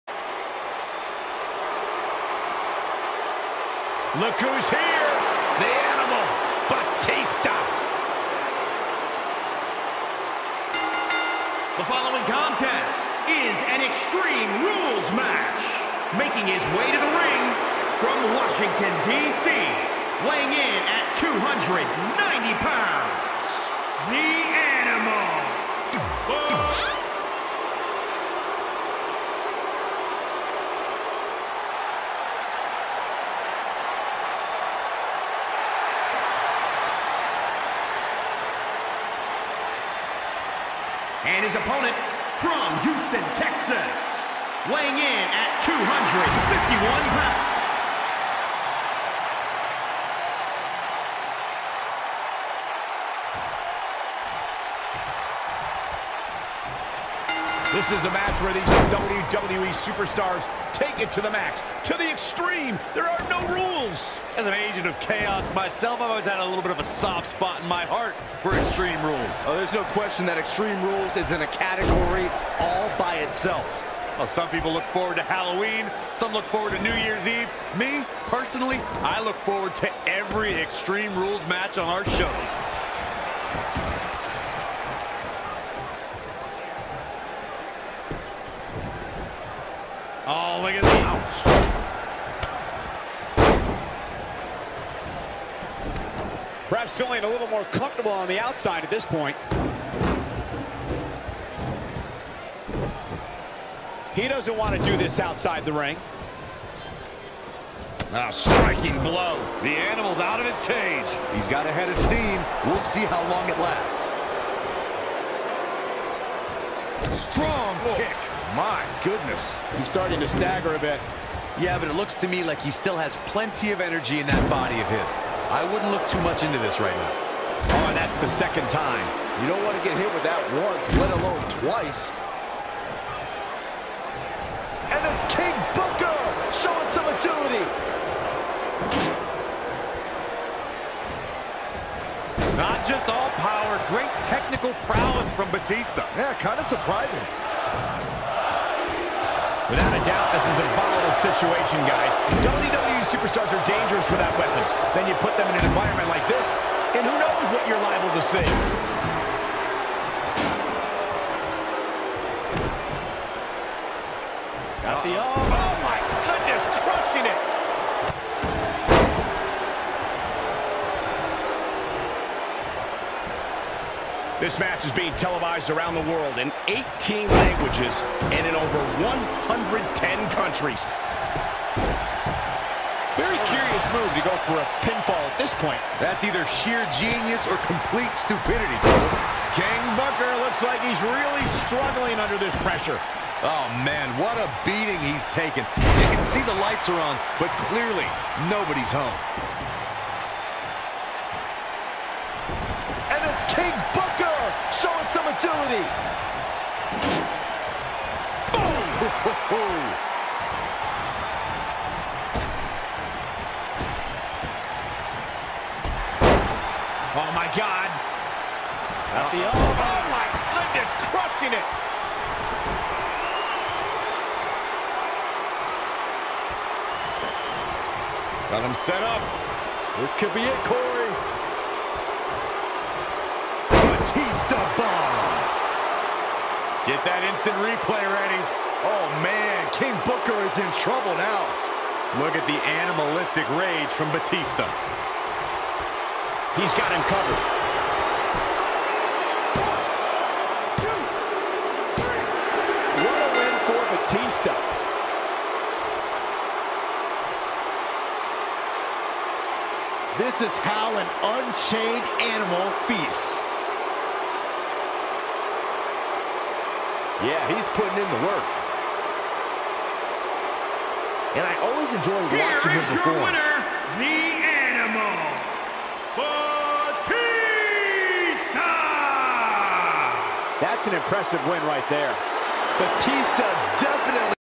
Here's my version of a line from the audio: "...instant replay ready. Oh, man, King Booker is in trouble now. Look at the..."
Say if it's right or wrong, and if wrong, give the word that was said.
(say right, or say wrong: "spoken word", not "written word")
right.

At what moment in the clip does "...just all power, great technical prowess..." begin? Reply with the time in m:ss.
2:22.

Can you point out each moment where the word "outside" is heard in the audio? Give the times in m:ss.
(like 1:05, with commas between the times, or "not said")
1:38, 1:45.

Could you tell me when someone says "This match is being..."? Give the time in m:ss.
2:54.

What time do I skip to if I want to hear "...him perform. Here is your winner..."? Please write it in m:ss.
4:32.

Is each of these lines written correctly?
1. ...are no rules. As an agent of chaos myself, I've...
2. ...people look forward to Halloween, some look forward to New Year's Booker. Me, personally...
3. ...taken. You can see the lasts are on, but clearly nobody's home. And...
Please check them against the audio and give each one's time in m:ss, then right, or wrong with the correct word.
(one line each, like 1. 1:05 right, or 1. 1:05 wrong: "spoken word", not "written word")
1. 1:03 right
2. 1:14 wrong: "Eve", not "Booker"
3. 3:15 wrong: "lights", not "lasts".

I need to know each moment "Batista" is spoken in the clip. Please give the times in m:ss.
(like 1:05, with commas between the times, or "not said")
0:06, 2:25, 4:04, 4:14, 4:36, 4:42.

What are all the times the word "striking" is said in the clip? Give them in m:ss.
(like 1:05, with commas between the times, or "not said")
1:48.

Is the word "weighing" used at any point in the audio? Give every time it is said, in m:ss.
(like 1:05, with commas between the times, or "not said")
0:20, 0:44.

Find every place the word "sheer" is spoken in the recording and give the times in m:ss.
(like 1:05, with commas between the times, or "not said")
3:06.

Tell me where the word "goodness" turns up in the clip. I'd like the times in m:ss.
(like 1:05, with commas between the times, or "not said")
1:59, 3:40.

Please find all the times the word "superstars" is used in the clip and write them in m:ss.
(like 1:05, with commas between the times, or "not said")
0:59, 2:33.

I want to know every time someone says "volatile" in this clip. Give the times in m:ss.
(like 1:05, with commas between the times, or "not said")
2:30.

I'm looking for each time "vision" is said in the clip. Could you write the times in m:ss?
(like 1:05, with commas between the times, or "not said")
not said.